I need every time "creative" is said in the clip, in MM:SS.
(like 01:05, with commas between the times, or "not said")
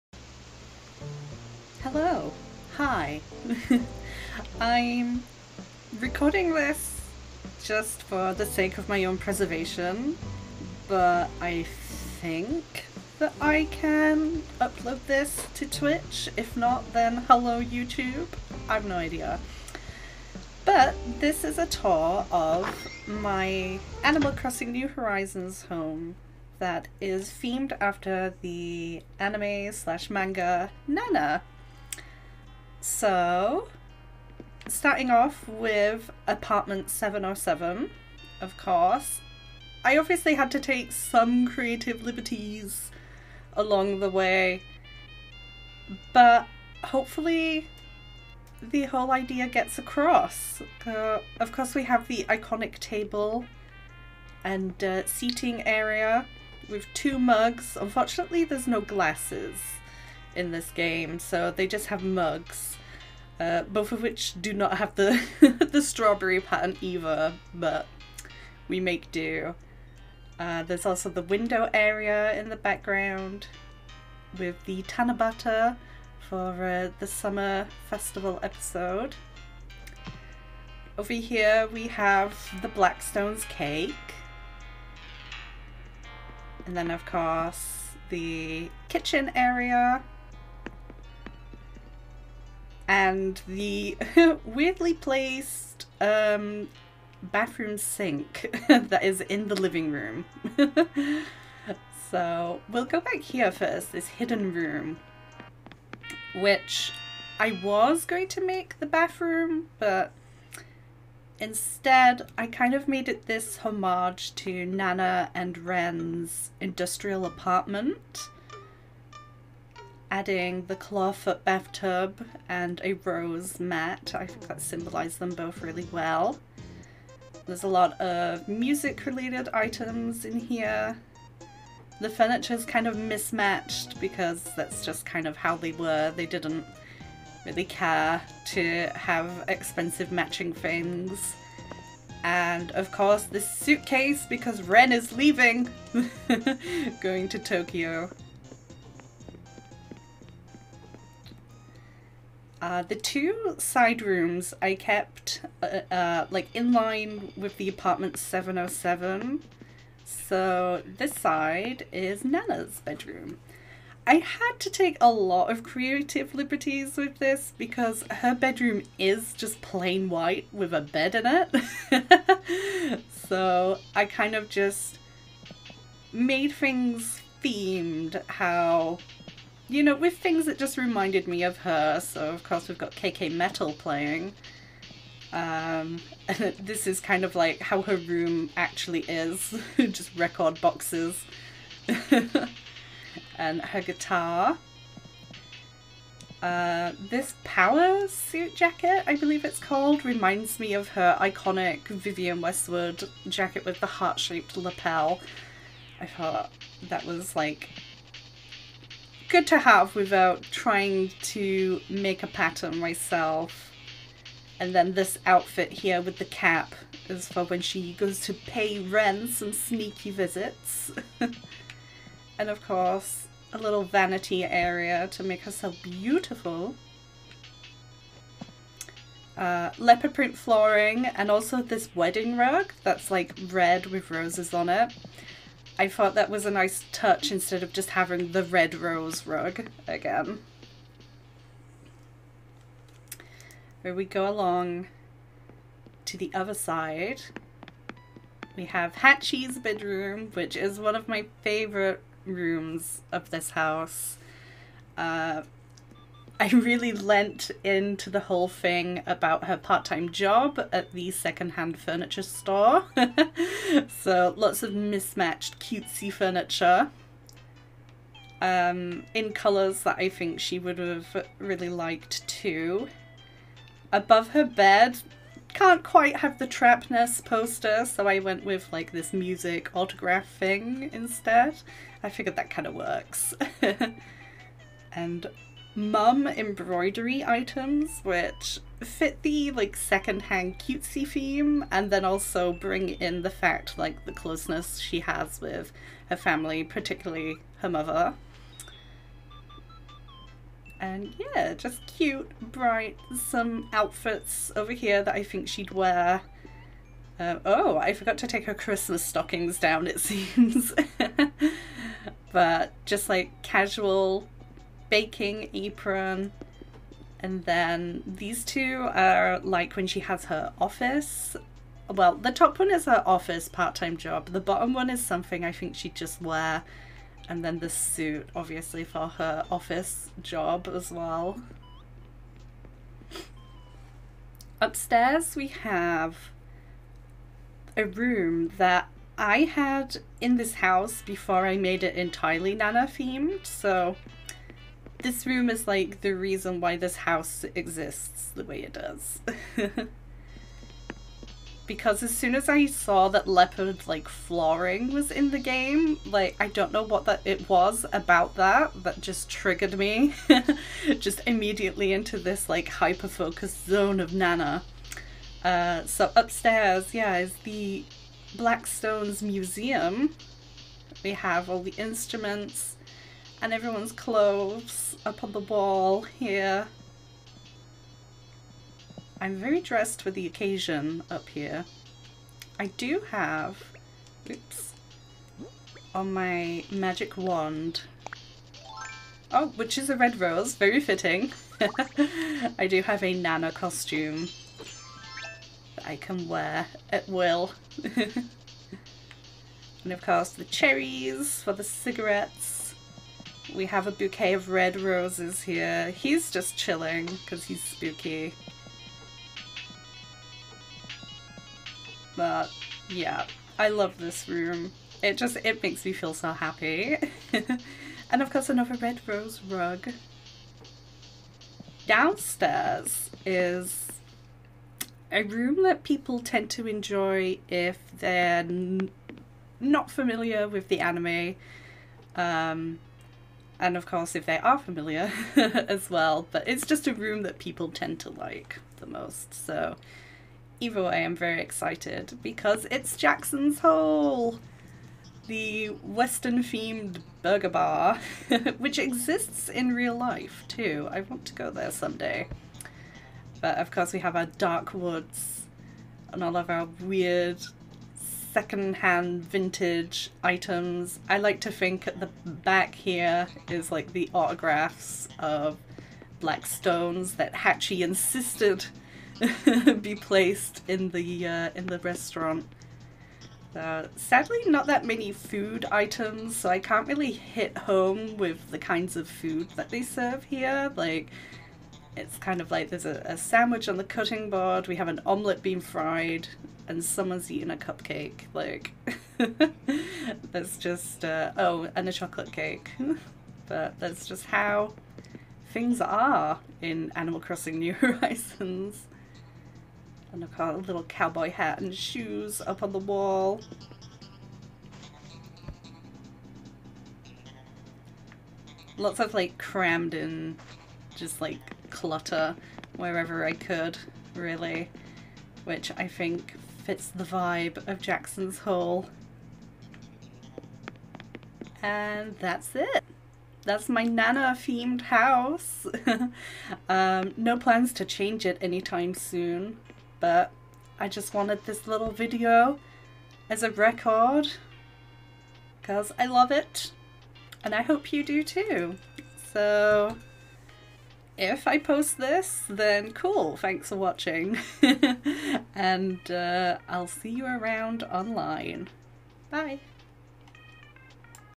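00:41, 02:45.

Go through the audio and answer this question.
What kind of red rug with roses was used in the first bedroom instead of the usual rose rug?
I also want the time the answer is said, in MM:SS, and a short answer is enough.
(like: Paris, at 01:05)
Wedding rug, at 03:51.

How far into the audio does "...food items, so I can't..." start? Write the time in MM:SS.
07:55.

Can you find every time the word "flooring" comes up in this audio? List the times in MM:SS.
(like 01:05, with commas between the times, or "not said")
03:50, 05:54.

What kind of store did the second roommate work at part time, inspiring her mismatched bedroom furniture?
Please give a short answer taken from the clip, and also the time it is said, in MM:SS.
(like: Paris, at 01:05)
Secondhand furniture store, at 04:21.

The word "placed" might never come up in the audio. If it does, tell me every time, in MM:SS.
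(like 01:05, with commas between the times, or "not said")
01:34, 07:49.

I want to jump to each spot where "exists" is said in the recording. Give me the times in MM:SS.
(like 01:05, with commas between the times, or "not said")
05:47, 07:28.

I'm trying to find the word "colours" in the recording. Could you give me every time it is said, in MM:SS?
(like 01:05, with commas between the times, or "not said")
04:29.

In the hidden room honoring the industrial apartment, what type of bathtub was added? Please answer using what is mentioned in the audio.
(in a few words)
Clawfoot bathtub.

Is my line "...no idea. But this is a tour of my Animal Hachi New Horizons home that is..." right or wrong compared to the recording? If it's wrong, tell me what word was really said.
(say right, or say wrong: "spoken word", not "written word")
wrong: "Crossing", not "Hachi".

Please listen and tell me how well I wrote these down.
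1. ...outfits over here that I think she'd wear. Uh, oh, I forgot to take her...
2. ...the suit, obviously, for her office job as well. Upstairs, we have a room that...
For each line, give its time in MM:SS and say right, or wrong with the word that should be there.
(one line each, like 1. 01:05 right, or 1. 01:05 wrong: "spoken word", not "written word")
1. 05:03 right
2. 05:27 right.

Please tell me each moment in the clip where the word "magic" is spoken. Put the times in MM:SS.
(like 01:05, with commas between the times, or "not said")
06:26.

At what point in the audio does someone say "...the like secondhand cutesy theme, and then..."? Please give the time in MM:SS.
04:49.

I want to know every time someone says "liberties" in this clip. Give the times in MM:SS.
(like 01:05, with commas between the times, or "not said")
00:42, 02:46.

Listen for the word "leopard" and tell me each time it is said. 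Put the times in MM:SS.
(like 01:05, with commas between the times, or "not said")
03:49, 05:53.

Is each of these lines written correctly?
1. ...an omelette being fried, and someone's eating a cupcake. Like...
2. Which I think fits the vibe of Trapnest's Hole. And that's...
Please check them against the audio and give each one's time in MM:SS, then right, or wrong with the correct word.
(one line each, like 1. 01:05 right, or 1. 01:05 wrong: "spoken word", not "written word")
1. 08:04 right
2. 08:35 wrong: "Jackson", not "Trapnest".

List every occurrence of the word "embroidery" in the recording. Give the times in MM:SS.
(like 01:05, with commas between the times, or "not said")
04:46.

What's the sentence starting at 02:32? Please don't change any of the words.
Uh, the two side rooms I kept uh, uh, like in line with the apartment 707.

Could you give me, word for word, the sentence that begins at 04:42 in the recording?
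I figured that kind of works.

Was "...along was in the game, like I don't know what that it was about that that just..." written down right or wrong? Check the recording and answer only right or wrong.
wrong.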